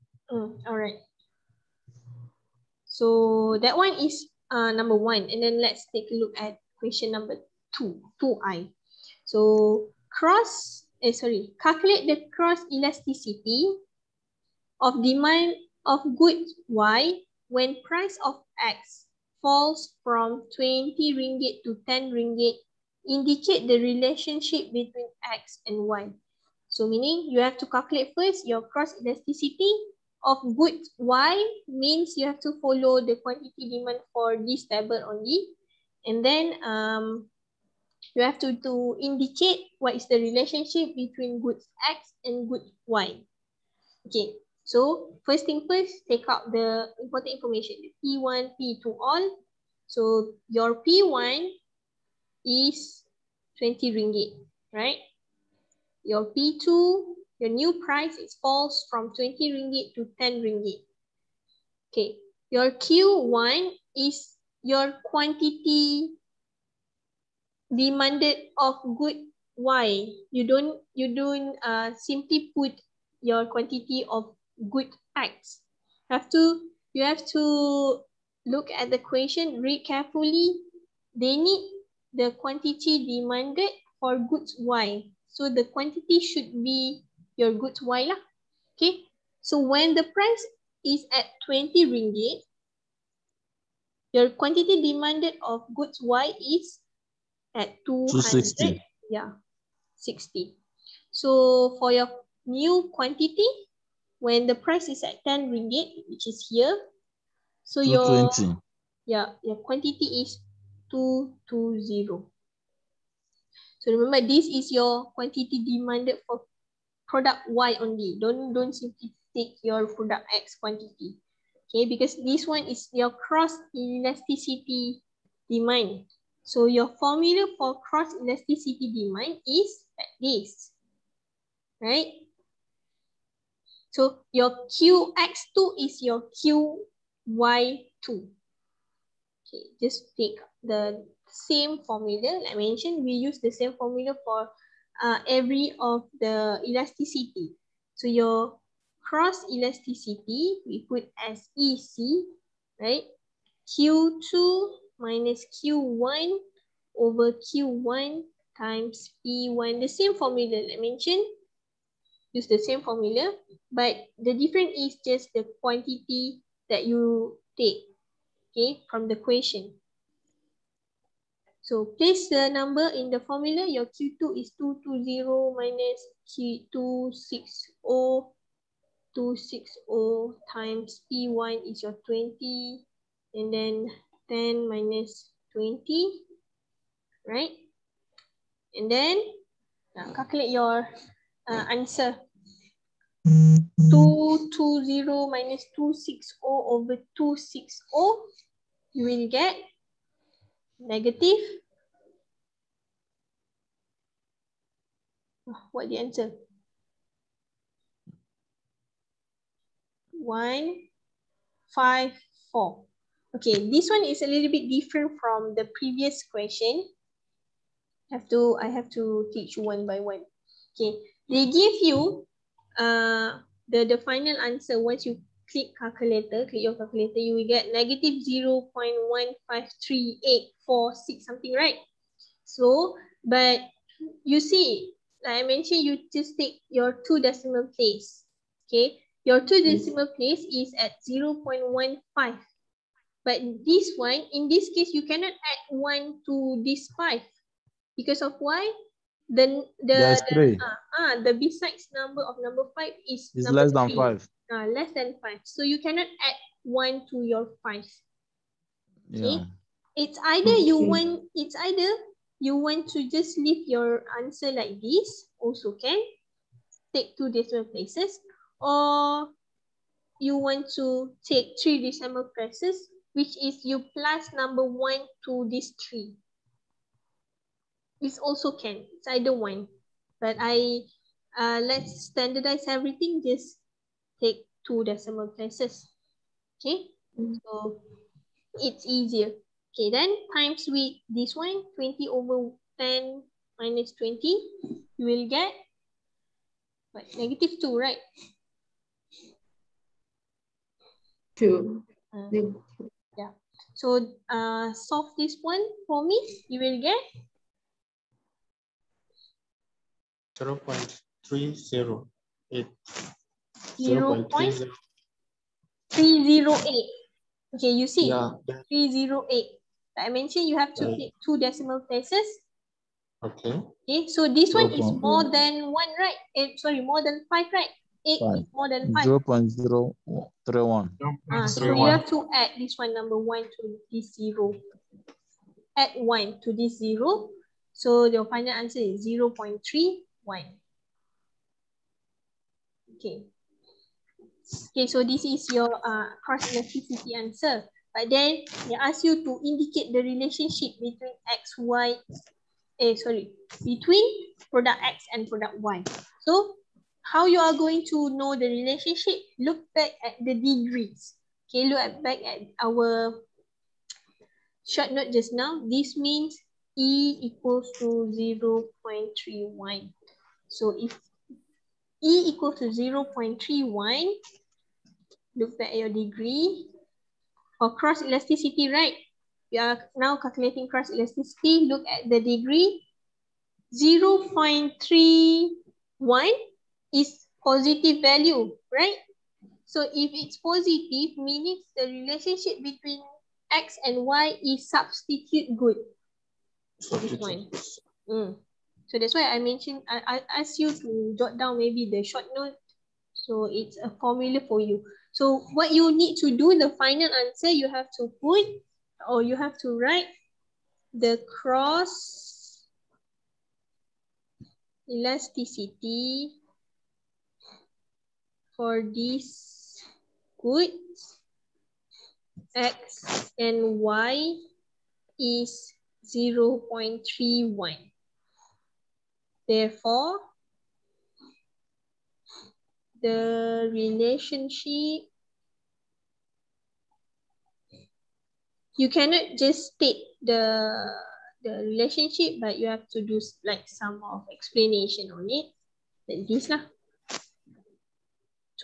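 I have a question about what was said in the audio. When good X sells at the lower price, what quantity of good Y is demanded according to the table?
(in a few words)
220.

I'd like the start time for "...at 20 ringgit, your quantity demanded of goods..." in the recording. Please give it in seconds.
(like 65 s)
91 s.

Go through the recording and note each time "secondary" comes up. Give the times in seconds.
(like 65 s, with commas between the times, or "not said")
not said.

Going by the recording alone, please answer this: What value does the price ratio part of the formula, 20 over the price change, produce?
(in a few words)
-2.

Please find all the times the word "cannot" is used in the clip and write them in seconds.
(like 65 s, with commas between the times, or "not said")
245 s, 255 s, 438 s.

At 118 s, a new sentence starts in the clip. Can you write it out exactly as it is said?
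Don't, don't simply take your product X quantity.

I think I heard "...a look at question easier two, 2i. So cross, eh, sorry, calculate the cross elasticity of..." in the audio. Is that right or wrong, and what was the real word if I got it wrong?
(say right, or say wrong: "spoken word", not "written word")
wrong: "number", not "easier".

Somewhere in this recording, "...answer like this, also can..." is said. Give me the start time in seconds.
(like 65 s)
264 s.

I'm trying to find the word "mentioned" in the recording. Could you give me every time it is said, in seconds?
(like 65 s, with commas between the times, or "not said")
142 s, 160 s, 235 s, 320 s, 399 s.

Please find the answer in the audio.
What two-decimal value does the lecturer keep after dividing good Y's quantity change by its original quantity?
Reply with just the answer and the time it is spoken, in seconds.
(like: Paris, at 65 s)
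-0.15, at 241 s.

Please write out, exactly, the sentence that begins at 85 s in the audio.
So the quantity should be your goods Y lah.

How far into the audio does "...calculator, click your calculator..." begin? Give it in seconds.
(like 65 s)
225 s.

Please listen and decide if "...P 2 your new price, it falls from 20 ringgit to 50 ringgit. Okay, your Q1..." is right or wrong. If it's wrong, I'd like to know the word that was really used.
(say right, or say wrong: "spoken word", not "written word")
wrong: "10", not "50".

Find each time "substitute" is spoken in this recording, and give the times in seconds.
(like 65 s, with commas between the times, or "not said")
394 s.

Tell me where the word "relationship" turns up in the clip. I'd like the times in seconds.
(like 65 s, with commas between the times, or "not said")
23 s, 40 s, 350 s, 358 s, 391 s, 433 s, 441 s.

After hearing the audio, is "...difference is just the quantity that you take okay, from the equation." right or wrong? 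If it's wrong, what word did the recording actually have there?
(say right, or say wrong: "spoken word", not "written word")
right.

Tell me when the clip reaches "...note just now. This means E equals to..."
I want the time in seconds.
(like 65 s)
364 s.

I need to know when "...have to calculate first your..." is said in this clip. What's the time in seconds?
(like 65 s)
27 s.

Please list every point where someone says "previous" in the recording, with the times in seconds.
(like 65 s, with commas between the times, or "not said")
215 s.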